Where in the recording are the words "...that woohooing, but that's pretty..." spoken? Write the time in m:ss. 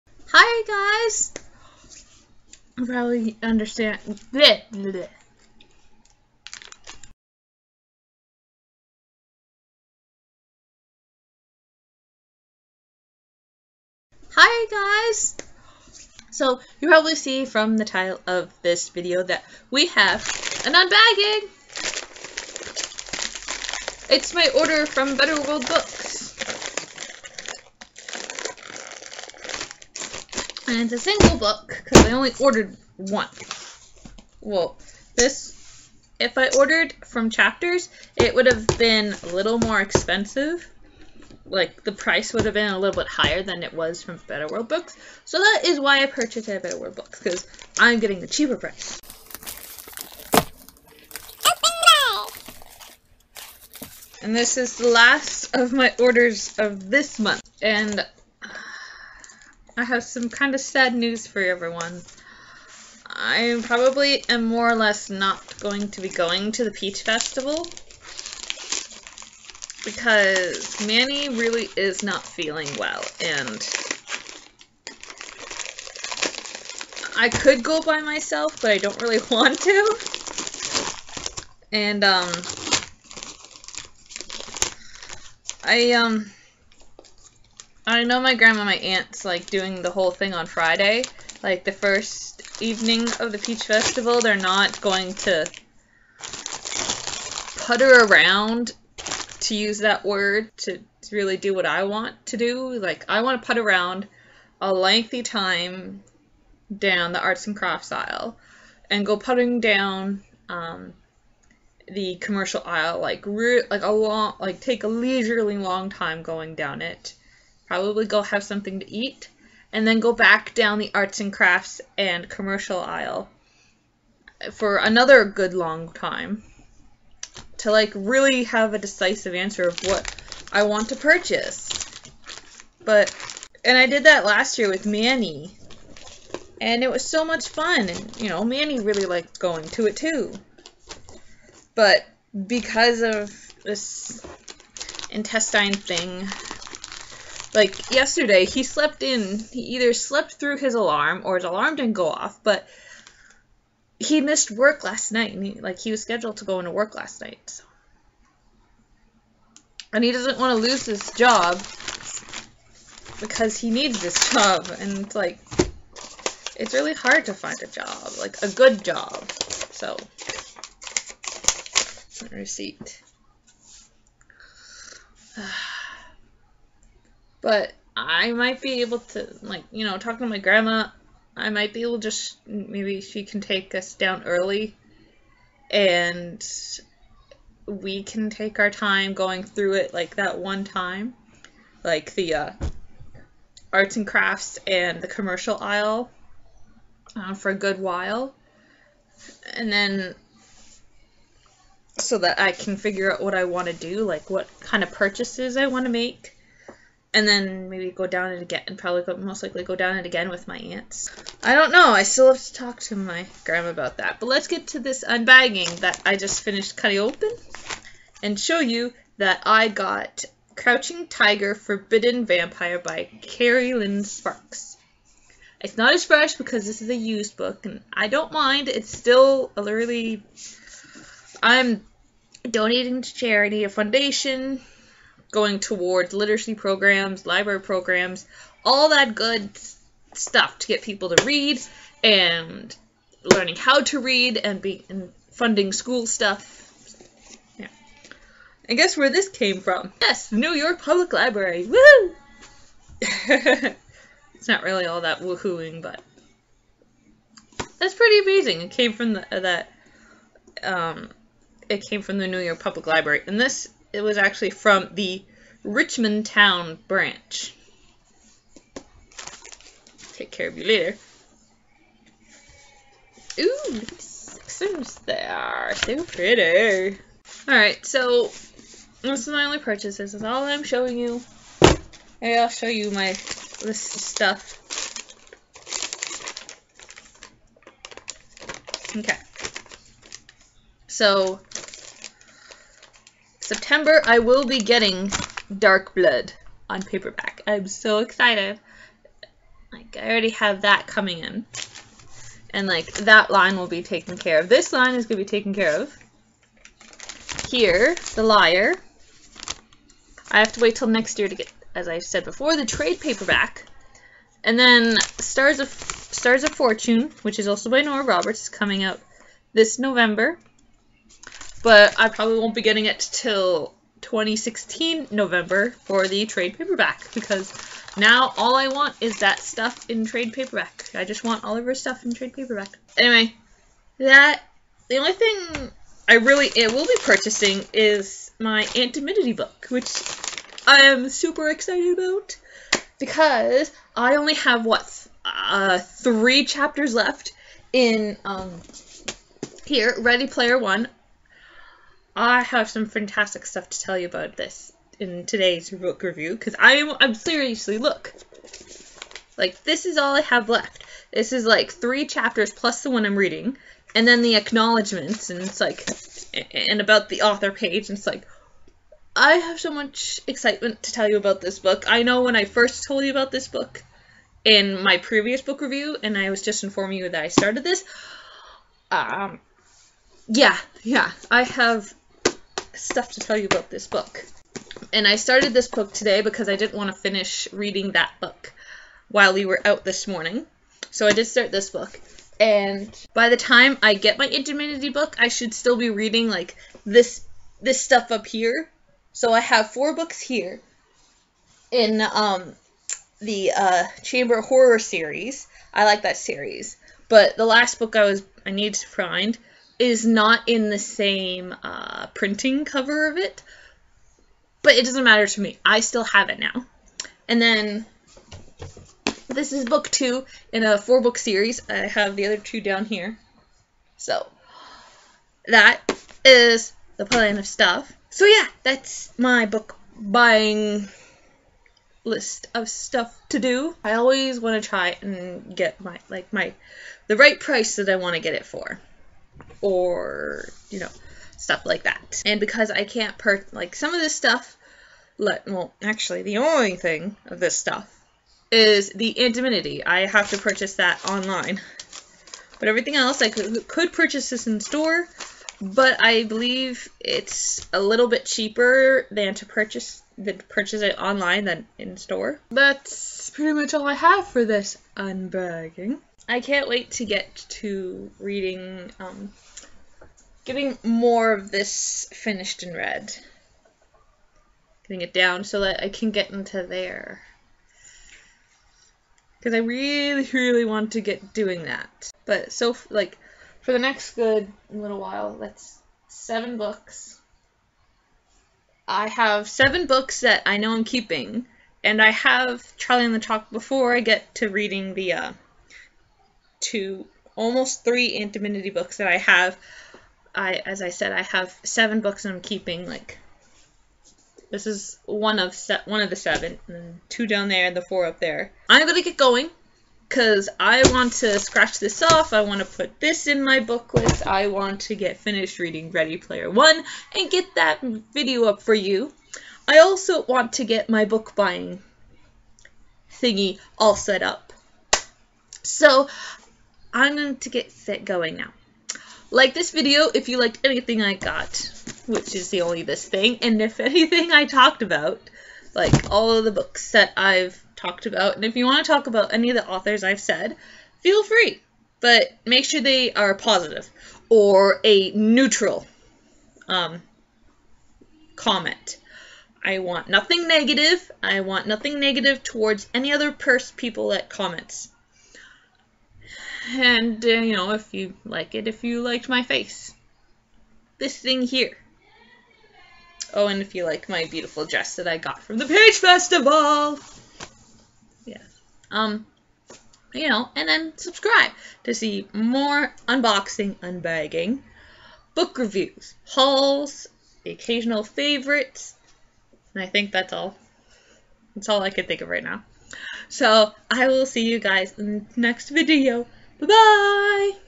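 4:15.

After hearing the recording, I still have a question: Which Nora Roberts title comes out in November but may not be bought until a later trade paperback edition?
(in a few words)
Stars of Fortune.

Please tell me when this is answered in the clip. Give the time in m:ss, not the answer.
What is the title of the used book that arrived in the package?
3:40.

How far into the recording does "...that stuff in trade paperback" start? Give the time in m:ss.
5:29.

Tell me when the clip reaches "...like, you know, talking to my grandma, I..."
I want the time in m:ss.
2:59.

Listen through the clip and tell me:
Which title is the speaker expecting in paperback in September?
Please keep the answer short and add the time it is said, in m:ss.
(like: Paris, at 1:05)
Dark Blood, at 4:55.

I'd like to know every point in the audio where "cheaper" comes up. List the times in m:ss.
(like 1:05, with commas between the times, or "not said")
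0:48, 7:38.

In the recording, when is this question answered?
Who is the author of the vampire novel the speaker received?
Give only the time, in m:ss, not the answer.
3:43.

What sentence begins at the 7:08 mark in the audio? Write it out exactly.
So yeah, that's my book buying list of stuff to do.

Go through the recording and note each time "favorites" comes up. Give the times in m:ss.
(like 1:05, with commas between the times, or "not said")
9:38.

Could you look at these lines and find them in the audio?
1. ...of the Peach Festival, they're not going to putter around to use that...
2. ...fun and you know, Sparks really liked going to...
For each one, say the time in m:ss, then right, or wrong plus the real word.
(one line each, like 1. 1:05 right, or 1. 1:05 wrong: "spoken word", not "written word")
1. 1:33 right
2. 2:17 wrong: "Manny", not "Sparks".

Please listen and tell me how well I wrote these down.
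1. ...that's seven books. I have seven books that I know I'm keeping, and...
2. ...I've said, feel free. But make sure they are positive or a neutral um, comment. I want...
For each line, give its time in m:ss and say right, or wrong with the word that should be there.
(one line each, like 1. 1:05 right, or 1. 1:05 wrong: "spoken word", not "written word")
1. 8:05 right
2. 9:00 right.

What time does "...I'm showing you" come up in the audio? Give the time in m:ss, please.
4:40.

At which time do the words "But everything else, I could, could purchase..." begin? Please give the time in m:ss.
7:32.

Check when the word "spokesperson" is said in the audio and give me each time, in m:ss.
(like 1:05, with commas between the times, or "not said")
not said.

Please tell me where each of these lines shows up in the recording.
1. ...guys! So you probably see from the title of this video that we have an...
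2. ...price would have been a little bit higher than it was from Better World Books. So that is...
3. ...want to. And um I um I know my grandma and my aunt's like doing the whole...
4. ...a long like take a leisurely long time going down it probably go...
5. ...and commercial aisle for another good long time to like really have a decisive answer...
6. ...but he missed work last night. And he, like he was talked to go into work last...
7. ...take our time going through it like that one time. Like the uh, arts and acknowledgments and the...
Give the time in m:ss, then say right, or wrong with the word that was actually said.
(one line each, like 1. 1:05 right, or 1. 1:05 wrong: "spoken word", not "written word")
1. 0:14 right
2. 0:41 right
3. 1:19 right
4. 1:53 right
5. 2:01 right
6. 2:32 wrong: "scheduled", not "talked"
7. 3:08 wrong: "crafts", not "acknowledgments".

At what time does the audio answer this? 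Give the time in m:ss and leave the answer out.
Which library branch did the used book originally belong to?
4:25.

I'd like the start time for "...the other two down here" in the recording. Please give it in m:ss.
7:02.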